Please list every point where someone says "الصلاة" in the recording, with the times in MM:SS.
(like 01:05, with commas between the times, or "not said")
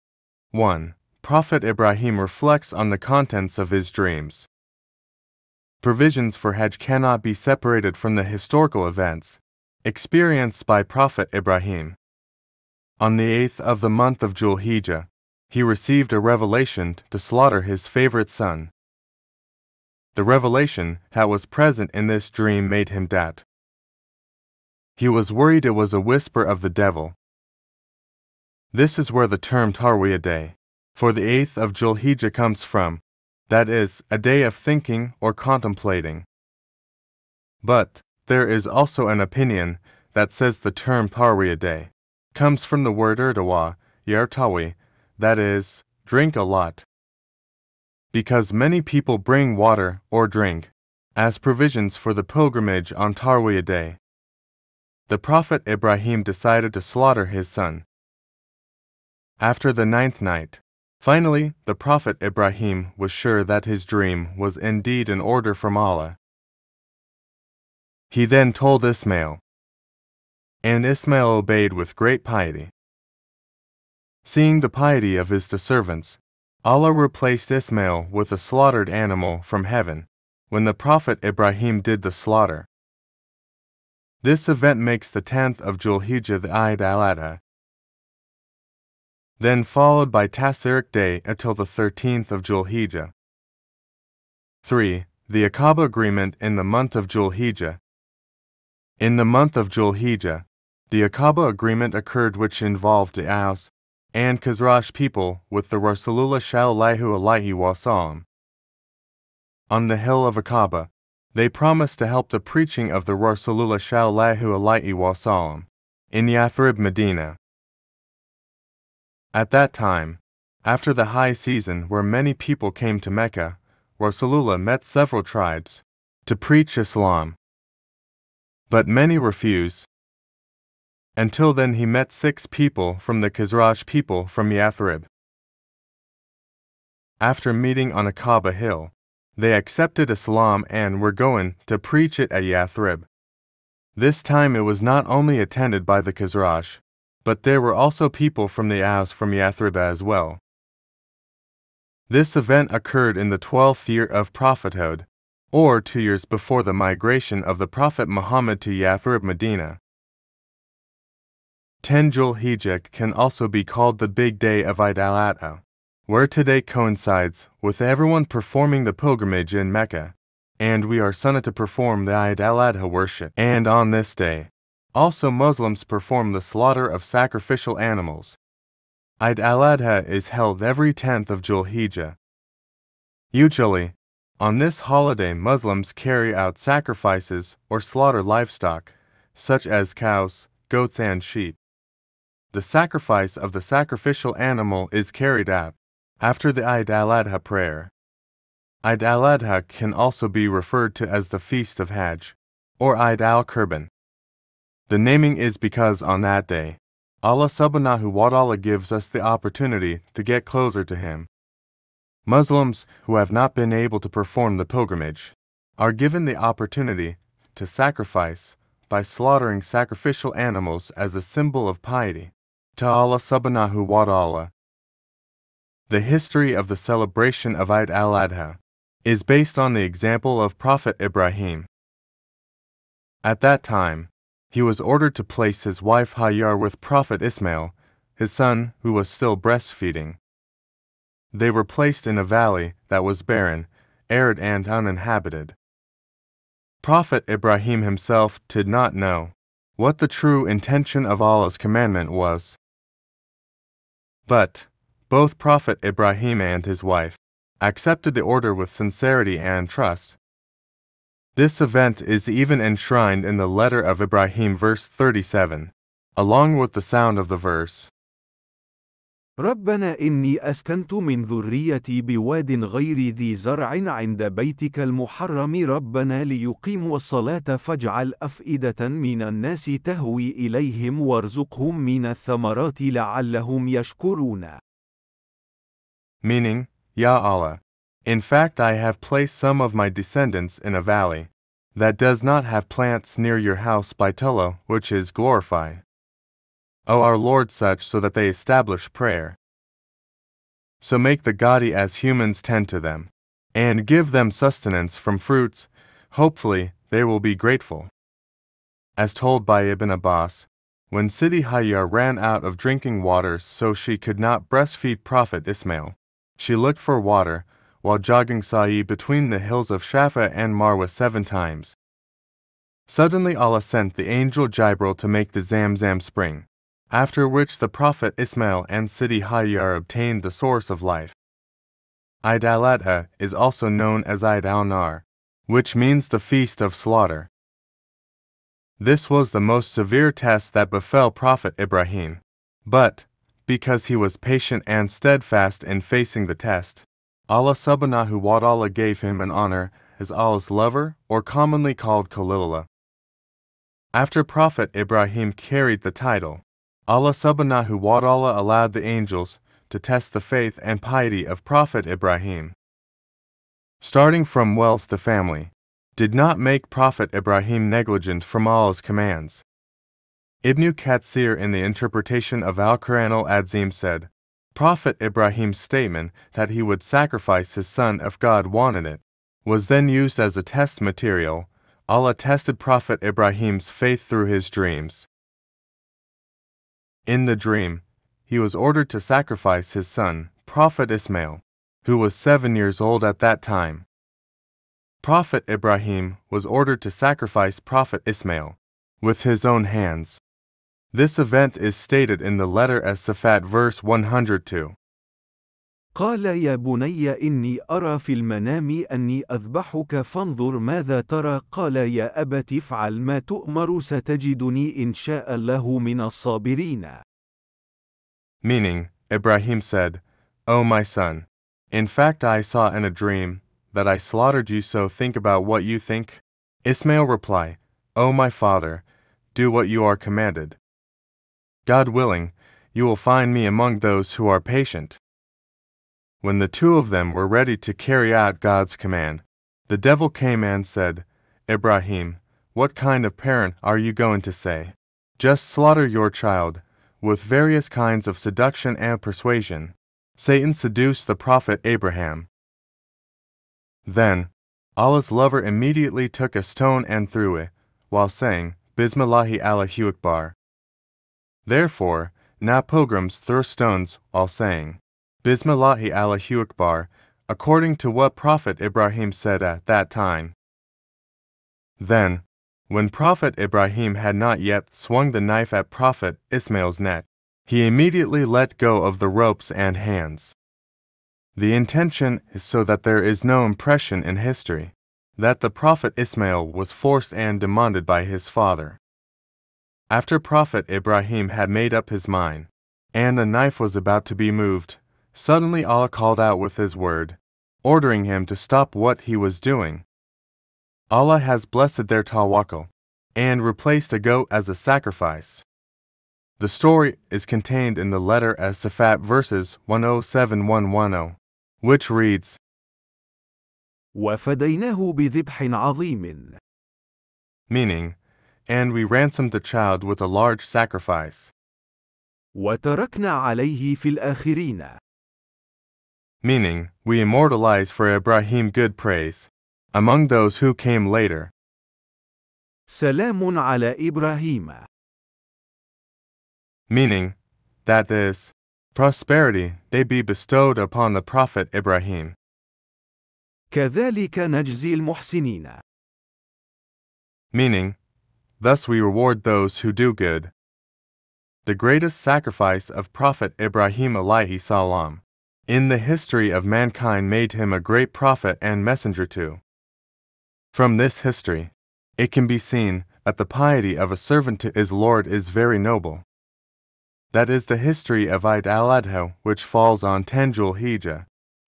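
04:36.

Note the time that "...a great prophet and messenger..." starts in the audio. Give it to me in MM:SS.
09:17.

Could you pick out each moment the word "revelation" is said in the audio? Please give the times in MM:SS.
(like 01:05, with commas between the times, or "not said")
00:16, 00:20.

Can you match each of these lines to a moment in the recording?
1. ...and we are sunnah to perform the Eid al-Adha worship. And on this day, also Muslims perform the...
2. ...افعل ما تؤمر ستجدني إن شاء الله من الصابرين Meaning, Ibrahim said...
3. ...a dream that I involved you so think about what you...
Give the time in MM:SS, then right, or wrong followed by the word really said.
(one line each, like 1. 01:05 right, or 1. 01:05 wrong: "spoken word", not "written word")
1. 02:50 right
2. 06:52 right
3. 07:02 wrong: "slaughtered", not "involved".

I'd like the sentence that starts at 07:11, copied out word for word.
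God willing, you will find me among those who are patient.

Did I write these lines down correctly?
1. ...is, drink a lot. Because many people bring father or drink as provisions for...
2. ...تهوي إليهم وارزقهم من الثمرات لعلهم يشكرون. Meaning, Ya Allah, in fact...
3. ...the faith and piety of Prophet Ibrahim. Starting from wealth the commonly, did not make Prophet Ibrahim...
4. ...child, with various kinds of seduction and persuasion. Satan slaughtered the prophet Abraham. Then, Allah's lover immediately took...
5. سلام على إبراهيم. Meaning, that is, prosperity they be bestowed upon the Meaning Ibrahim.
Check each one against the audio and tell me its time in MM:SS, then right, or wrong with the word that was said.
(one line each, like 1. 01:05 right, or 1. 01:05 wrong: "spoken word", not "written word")
1. 00:45 wrong: "water", not "father"
2. 04:39 right
3. 06:00 wrong: "family", not "commonly"
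4. 07:26 wrong: "seduced", not "slaughtered"
5. 08:52 wrong: "Prophet", not "Meaning".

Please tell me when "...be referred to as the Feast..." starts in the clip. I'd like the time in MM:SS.
03:20.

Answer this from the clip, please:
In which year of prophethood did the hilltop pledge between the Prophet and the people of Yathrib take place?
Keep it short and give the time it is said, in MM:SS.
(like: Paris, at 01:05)
Twelfth year, at 02:33.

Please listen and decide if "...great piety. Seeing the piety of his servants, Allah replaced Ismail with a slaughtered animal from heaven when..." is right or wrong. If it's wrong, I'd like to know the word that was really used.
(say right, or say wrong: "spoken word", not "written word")
right.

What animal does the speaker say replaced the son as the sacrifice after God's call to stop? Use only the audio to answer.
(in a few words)
A goat.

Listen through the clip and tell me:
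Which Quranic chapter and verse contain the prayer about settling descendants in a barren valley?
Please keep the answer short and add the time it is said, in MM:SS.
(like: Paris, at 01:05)
Ibrahim, verse 37, at 04:23.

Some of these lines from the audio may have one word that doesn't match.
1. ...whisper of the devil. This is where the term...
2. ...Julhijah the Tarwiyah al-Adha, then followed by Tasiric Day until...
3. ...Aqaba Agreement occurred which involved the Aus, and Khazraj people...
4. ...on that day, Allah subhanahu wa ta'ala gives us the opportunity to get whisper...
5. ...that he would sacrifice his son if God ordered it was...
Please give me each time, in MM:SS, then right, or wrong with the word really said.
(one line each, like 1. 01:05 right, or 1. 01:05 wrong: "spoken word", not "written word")
1. 00:26 right
2. 01:25 wrong: "Eid", not "Tarwiyah"
3. 01:41 right
4. 03:26 wrong: "closer", not "whisper"
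5. 06:16 wrong: "wanted", not "ordered".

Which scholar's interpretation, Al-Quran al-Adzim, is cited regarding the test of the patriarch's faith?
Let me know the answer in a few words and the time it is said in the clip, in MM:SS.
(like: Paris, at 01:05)
Ibn Katsir, at 06:10.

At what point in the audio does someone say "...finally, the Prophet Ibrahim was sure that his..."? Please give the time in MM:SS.
01:01.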